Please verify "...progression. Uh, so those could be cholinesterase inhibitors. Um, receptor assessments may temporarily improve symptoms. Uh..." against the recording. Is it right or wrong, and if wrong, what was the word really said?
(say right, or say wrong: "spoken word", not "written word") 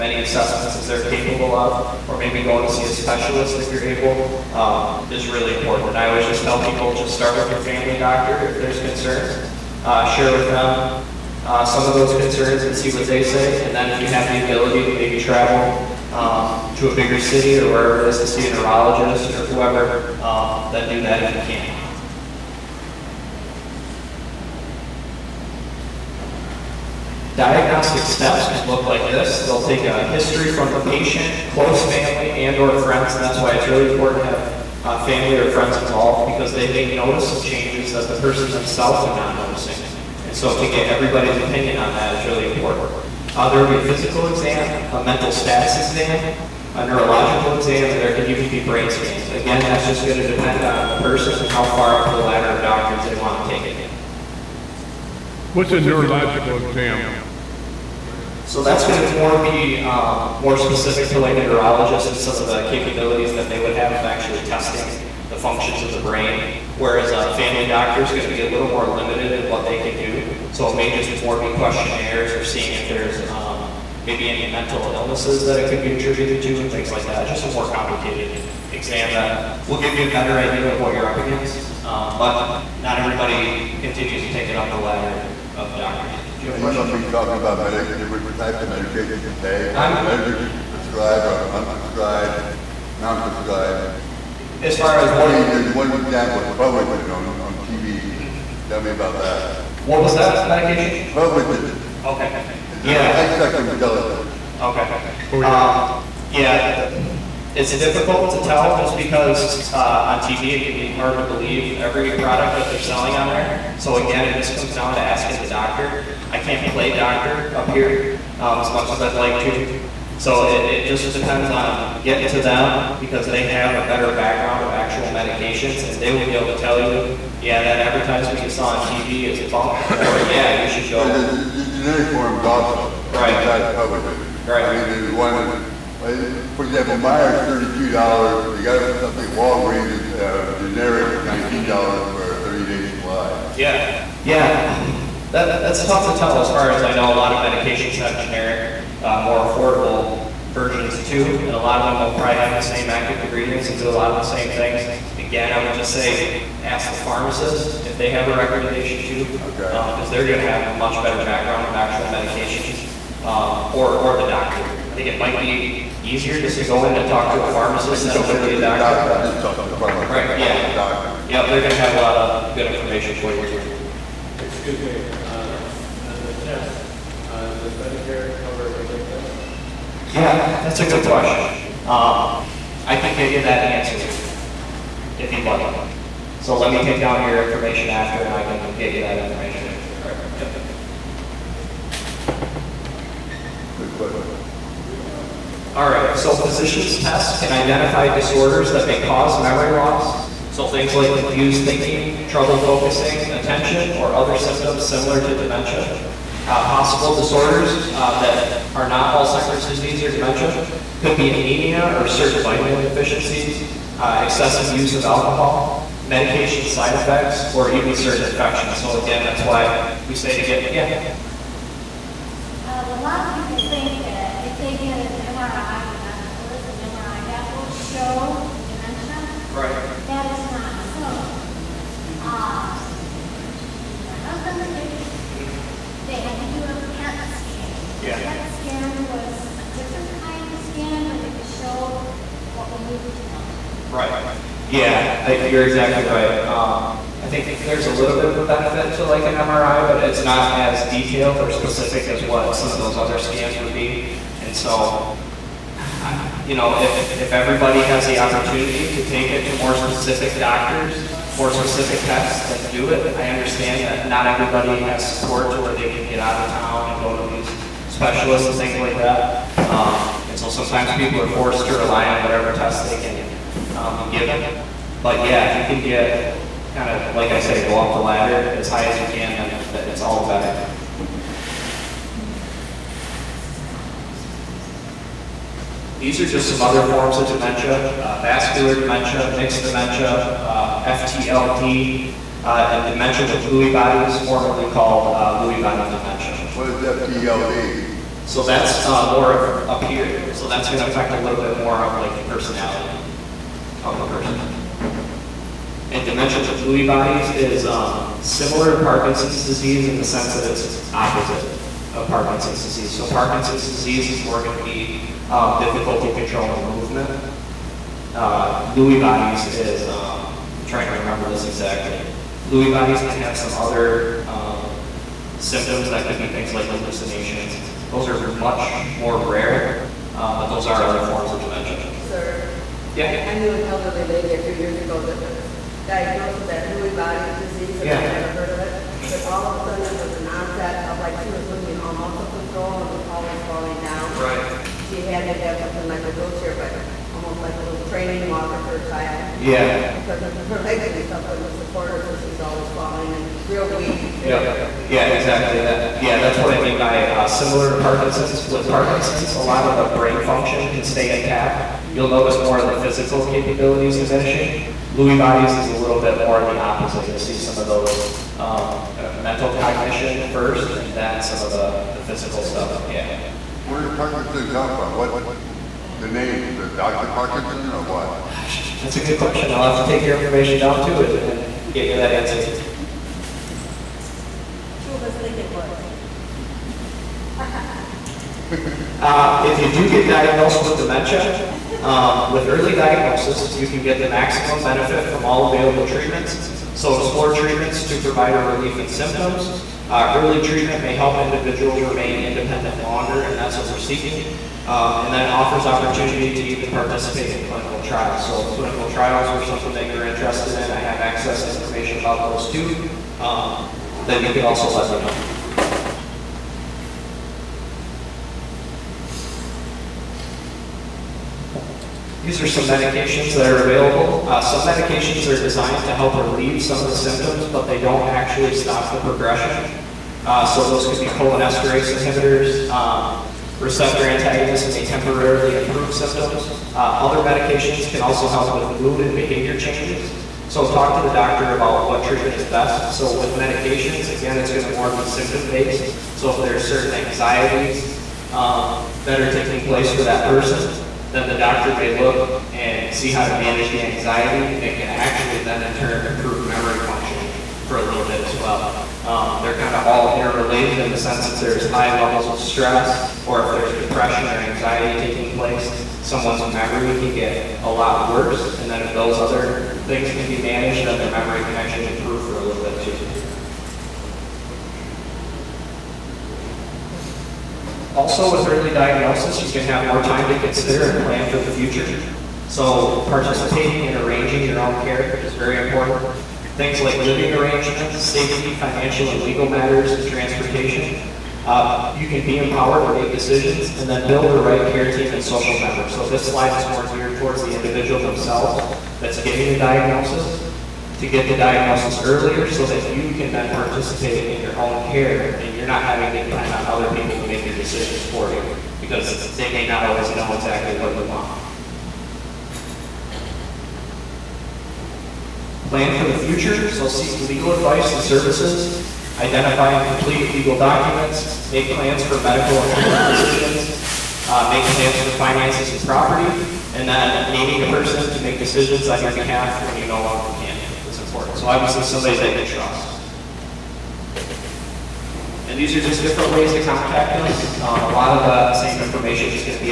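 wrong: "antagonists", not "assessments".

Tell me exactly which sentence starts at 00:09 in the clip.
Uh, share with them uh, some of those concerns and see what they say.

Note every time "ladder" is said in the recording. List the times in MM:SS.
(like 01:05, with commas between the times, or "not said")
00:52, 01:24, 04:38.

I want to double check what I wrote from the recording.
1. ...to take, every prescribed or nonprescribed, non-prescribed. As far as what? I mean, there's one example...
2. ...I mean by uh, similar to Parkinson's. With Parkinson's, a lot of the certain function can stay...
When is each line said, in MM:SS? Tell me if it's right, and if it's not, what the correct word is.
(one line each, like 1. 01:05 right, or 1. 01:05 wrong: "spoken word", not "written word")
1. 01:29 wrong: "unprescribed", not "nonprescribed"
2. 05:56 wrong: "brain", not "certain".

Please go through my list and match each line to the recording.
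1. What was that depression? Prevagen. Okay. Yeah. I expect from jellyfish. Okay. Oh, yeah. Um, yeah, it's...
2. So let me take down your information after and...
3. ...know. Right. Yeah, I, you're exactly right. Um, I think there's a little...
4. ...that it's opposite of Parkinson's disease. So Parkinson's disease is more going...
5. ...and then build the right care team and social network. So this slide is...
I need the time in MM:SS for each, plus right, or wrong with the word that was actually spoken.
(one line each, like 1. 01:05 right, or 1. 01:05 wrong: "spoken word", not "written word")
1. 01:39 wrong: "medication", not "depression"
2. 03:06 right
3. 04:03 right
4. 05:10 right
5. 08:13 right.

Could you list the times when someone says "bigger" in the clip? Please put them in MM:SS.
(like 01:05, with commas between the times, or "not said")
00:16.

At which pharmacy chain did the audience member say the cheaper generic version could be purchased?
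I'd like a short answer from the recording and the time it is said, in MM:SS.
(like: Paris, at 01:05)
Walgreens, at 02:19.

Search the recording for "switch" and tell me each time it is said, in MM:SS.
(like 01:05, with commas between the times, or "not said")
not said.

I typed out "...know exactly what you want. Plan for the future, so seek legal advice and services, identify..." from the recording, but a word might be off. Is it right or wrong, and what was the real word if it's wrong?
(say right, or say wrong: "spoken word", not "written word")
right.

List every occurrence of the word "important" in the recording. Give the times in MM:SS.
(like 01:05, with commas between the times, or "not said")
00:05, 00:33, 00:42, 08:05, 08:51.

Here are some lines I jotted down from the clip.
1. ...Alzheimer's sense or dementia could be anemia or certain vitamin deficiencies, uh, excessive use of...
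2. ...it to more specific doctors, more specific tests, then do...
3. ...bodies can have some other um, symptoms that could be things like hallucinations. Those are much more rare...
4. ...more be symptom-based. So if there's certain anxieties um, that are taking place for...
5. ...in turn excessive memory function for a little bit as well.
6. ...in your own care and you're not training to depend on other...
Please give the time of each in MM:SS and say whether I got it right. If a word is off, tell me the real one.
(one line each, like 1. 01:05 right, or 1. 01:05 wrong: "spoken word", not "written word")
1. 03:29 wrong: "disease", not "sense"
2. 04:19 right
3. 05:22 right
4. 07:24 right
5. 07:35 wrong: "improve", not "excessive"
6. 08:24 wrong: "having", not "training".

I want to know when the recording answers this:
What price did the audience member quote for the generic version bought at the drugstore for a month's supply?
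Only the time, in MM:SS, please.
02:21.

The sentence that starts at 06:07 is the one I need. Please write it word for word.
You'll see some of those um, uh, mental cognition first, and then some of the, the physical stuff.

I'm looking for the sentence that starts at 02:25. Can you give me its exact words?
That, that's tough to tell as far as I know.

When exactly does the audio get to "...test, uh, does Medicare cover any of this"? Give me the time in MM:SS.
02:56.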